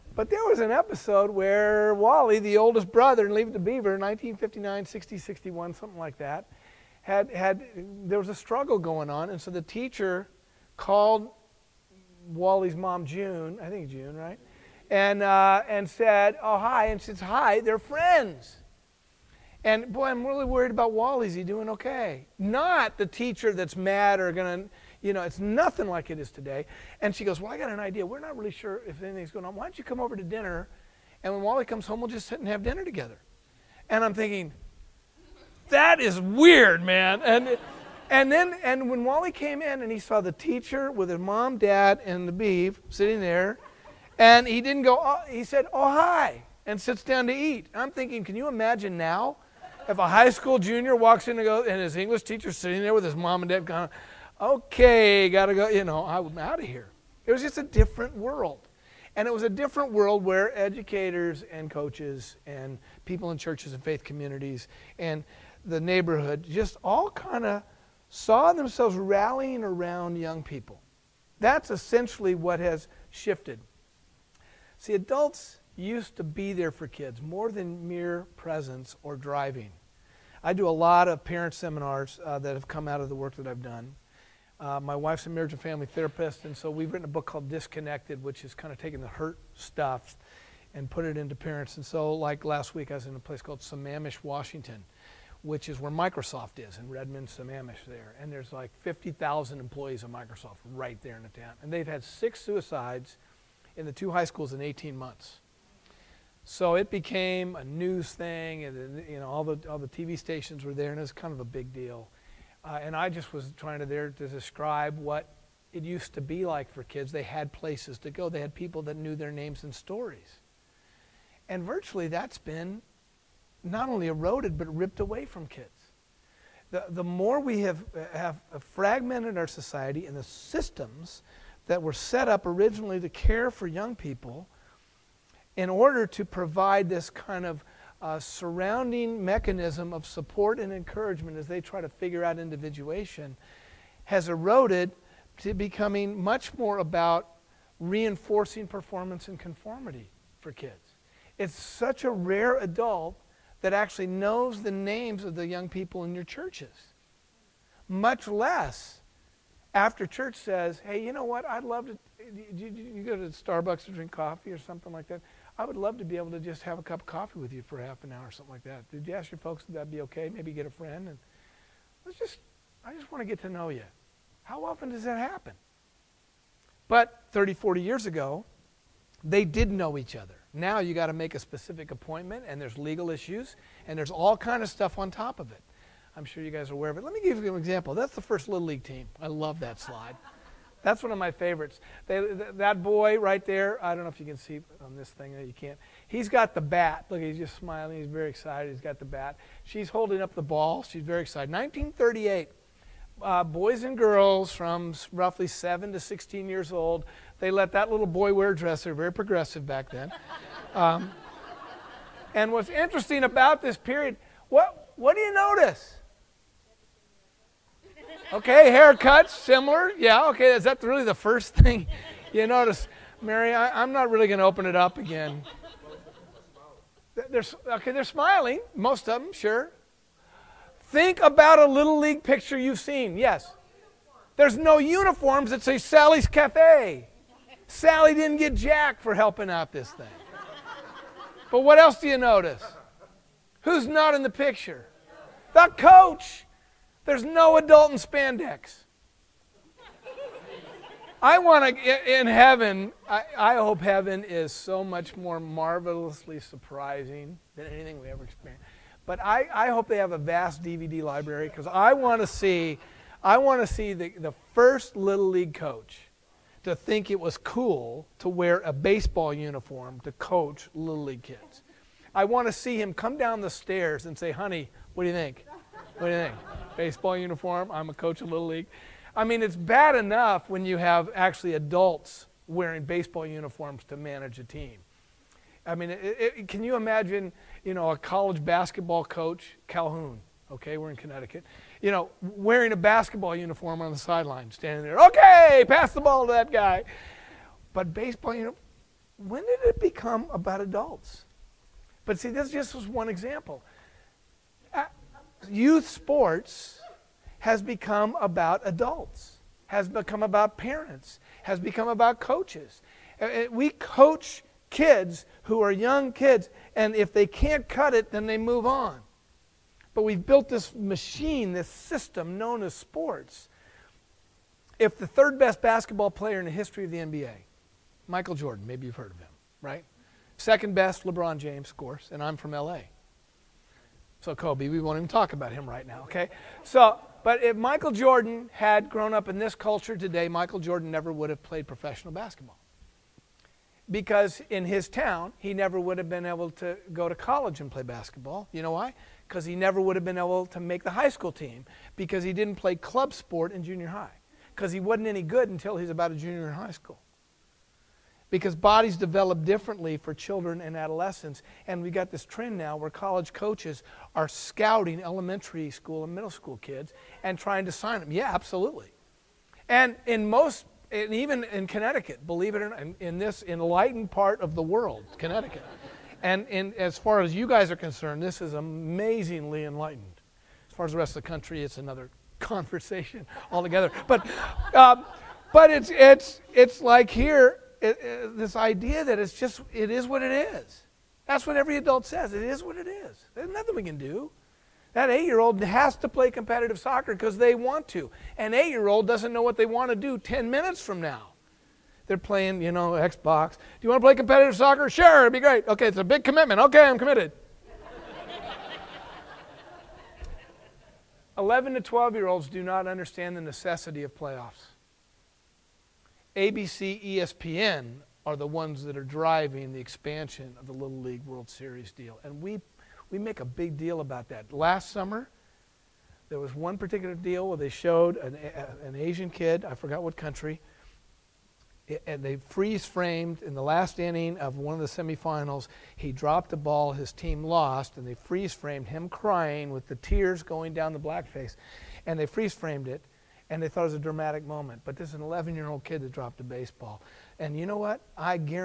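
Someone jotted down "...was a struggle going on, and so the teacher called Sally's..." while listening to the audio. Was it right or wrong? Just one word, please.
wrong.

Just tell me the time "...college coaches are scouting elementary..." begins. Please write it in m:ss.
6:02.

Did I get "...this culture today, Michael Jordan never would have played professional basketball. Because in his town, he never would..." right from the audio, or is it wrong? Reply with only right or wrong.
right.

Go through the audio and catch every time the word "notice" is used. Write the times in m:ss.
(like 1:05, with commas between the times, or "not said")
3:35, 3:42, 4:02.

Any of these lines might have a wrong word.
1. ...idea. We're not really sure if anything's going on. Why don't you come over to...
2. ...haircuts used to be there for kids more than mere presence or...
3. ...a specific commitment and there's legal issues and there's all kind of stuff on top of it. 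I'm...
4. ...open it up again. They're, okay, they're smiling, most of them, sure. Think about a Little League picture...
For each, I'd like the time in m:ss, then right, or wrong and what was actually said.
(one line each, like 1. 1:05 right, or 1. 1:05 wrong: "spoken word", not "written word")
1. 0:27 right
2. 1:14 wrong: "adults", not "haircuts"
3. 3:01 wrong: "appointment", not "commitment"
4. 3:44 right.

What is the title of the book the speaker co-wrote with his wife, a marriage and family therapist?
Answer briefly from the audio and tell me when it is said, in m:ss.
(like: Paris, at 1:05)
Disconnected, at 1:27.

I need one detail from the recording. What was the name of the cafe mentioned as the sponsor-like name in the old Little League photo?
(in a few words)
Sally's Cafe.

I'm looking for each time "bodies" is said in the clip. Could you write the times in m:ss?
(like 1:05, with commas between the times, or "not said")
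5:58.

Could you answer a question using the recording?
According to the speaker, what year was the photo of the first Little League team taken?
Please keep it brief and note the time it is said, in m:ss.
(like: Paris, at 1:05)
1938, at 3:21.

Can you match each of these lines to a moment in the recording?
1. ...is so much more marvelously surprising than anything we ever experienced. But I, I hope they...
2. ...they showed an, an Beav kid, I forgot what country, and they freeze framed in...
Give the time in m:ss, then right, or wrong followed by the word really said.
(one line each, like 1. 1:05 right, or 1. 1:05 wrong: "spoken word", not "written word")
1. 4:14 right
2. 7:07 wrong: "Asian", not "Beav".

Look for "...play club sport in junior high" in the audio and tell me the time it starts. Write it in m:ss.
5:52.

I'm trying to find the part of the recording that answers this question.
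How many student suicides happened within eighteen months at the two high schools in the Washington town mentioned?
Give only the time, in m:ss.
1:42.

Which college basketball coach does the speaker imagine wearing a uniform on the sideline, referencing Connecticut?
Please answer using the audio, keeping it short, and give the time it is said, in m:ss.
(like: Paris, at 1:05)
Calhoun, at 4:49.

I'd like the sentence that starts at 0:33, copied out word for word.
And I'm thinking, That is weird, man.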